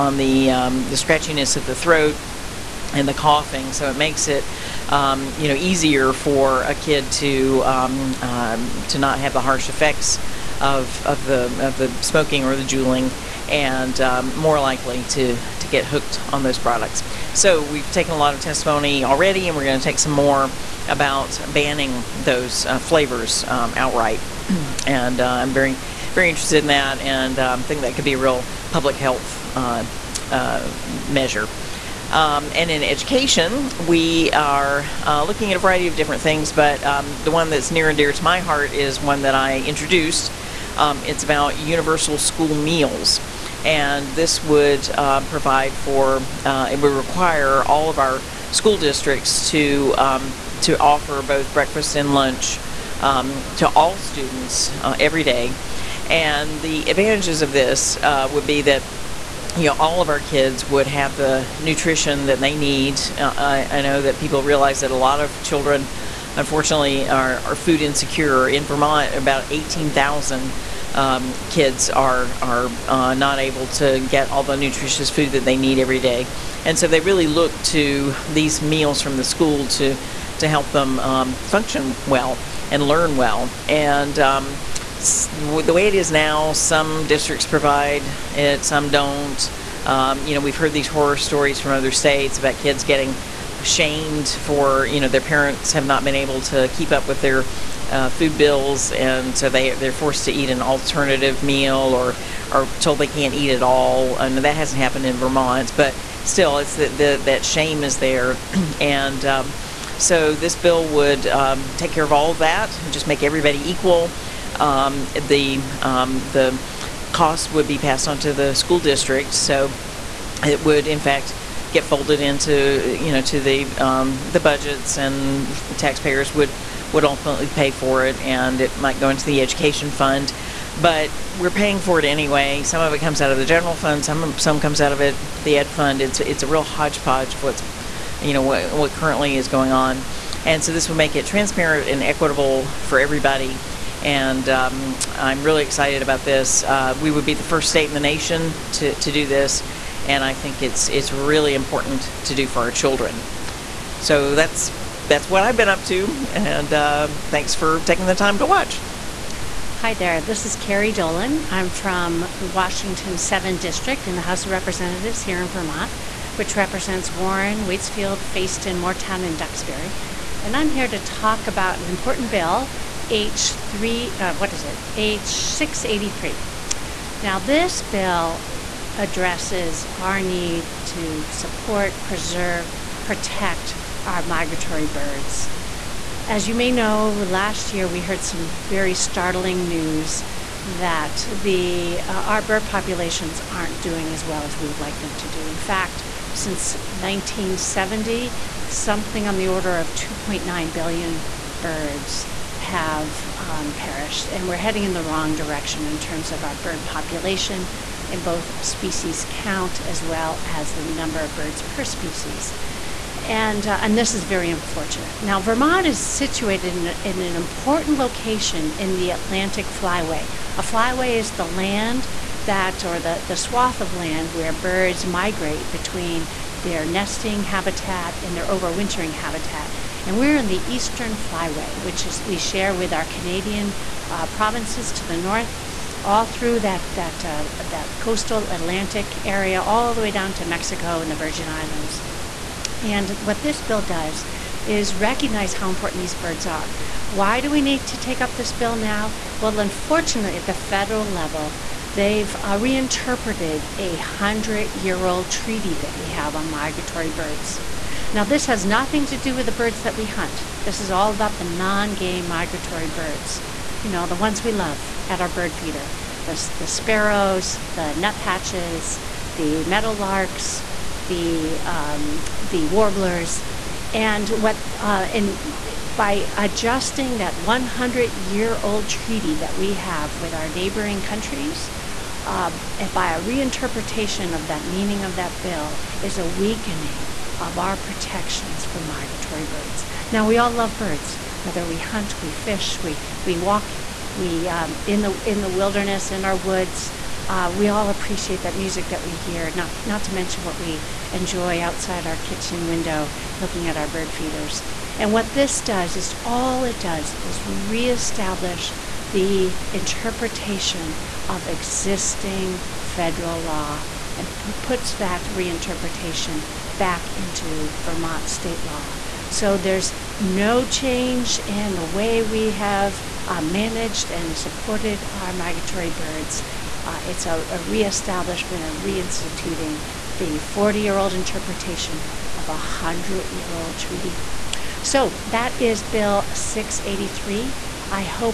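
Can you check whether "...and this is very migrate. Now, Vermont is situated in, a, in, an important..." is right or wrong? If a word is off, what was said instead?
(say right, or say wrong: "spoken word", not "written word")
wrong: "unfortunate", not "migrate".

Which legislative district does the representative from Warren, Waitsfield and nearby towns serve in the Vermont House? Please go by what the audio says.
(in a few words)
Washington 7.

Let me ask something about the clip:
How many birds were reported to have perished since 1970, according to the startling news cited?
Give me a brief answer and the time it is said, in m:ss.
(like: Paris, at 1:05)
2.9 billion, at 3:19.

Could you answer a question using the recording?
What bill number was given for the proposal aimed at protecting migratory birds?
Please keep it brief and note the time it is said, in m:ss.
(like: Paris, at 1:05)
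H683, at 2:54.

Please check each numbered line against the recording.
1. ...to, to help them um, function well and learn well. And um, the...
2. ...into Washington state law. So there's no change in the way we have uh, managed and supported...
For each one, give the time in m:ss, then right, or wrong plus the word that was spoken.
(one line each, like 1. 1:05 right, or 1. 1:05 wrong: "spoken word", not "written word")
1. 1:19 right
2. 5:17 wrong: "Vermont", not "Washington".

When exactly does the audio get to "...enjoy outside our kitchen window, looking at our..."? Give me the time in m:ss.
5:01.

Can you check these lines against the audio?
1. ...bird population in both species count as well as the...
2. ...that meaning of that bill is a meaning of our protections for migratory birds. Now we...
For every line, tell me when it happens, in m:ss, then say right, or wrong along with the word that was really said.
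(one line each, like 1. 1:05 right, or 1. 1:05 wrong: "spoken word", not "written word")
1. 3:26 right
2. 4:44 wrong: "weakening", not "meaning".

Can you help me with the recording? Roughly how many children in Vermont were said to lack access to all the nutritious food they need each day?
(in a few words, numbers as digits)
18,000.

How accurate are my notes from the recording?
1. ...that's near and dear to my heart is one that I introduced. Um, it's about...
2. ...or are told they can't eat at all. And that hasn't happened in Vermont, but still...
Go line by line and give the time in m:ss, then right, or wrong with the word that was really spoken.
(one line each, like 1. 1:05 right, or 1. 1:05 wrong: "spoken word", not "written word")
1. 0:37 right
2. 1:41 right.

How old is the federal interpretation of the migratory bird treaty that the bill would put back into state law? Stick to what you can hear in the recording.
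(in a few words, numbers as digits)
40 years.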